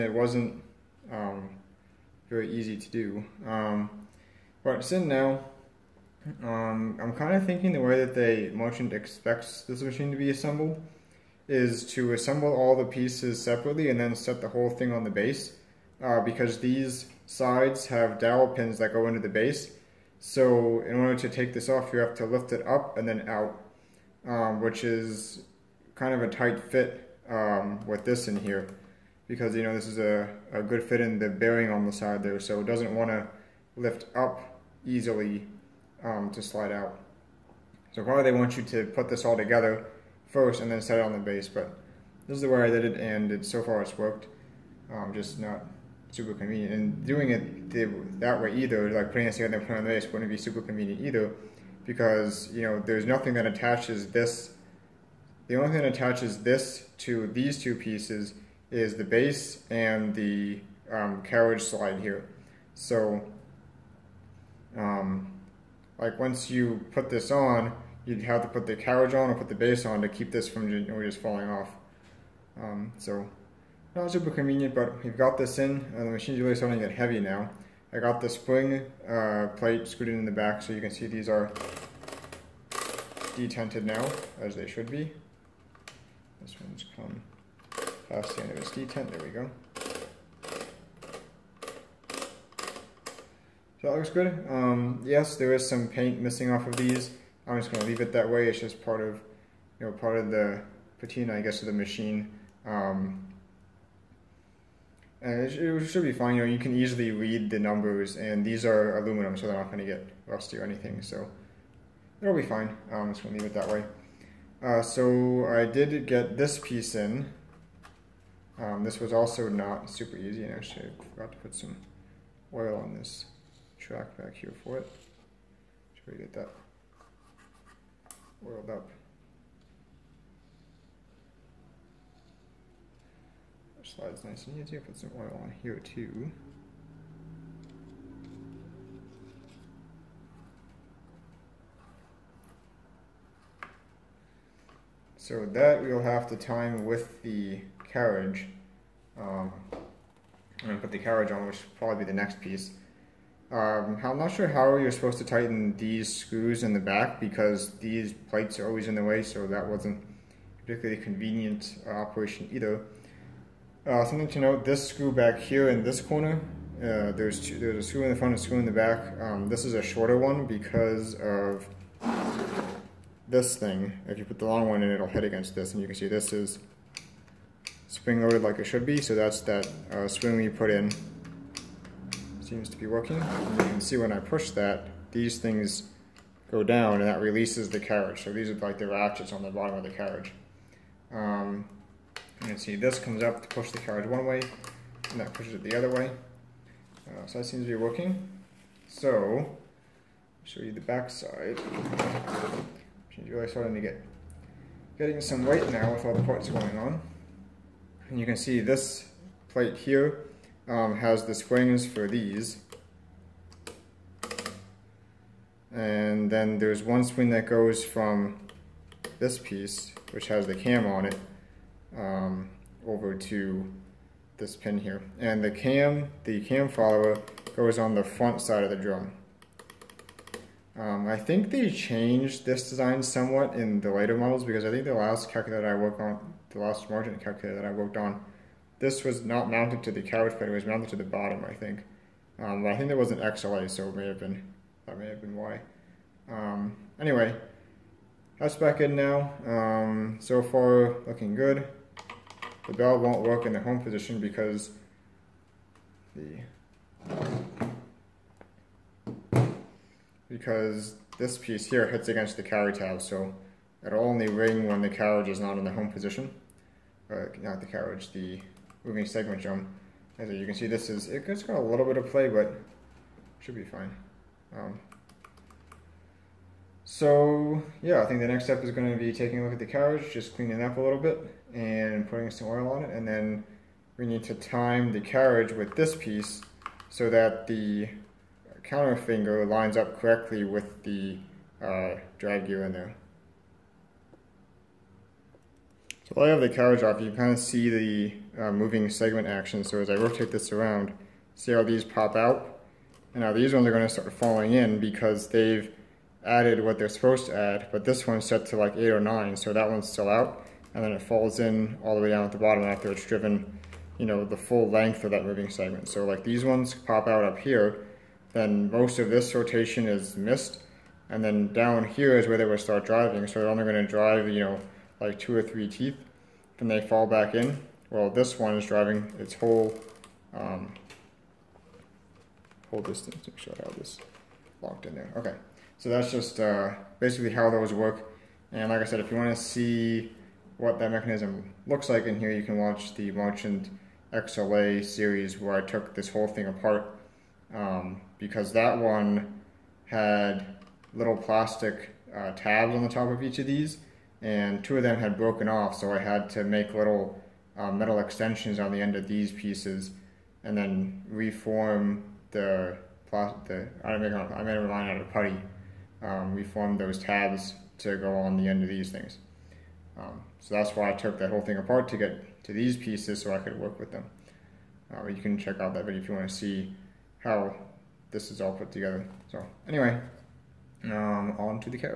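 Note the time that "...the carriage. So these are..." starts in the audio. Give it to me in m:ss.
3:07.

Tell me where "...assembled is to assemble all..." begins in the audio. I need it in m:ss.
0:10.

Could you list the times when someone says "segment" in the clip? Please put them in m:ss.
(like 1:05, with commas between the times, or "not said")
4:29, 4:58, 5:15.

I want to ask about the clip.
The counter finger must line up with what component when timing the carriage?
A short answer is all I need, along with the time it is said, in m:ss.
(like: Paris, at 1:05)
Drag gear, at 4:52.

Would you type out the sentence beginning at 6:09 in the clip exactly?
Um, so that's why I took that whole thing apart to get to these pieces so I could work with them.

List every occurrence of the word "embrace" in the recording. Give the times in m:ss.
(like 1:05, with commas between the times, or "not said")
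not said.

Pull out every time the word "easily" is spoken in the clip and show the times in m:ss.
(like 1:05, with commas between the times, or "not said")
0:34, 1:46.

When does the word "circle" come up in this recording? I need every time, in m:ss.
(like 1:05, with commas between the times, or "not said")
not said.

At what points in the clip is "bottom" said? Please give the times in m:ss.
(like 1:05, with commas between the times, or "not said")
3:09, 4:01, 5:12.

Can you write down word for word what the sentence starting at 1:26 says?
This one's come past the end of its detent, there we go.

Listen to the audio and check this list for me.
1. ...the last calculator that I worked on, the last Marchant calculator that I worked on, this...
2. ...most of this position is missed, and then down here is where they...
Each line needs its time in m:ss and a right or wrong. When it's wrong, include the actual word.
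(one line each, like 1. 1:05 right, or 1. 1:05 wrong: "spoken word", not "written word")
1. 3:54 right
2. 5:18 wrong: "rotation", not "position".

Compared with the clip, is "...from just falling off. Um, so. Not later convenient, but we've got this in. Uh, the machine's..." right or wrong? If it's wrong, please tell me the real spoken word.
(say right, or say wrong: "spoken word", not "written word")
wrong: "super", not "later".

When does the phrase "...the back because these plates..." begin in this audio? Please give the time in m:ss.
2:36.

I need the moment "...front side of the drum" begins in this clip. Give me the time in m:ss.
3:48.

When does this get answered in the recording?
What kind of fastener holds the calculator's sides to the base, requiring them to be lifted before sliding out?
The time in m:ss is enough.
0:18.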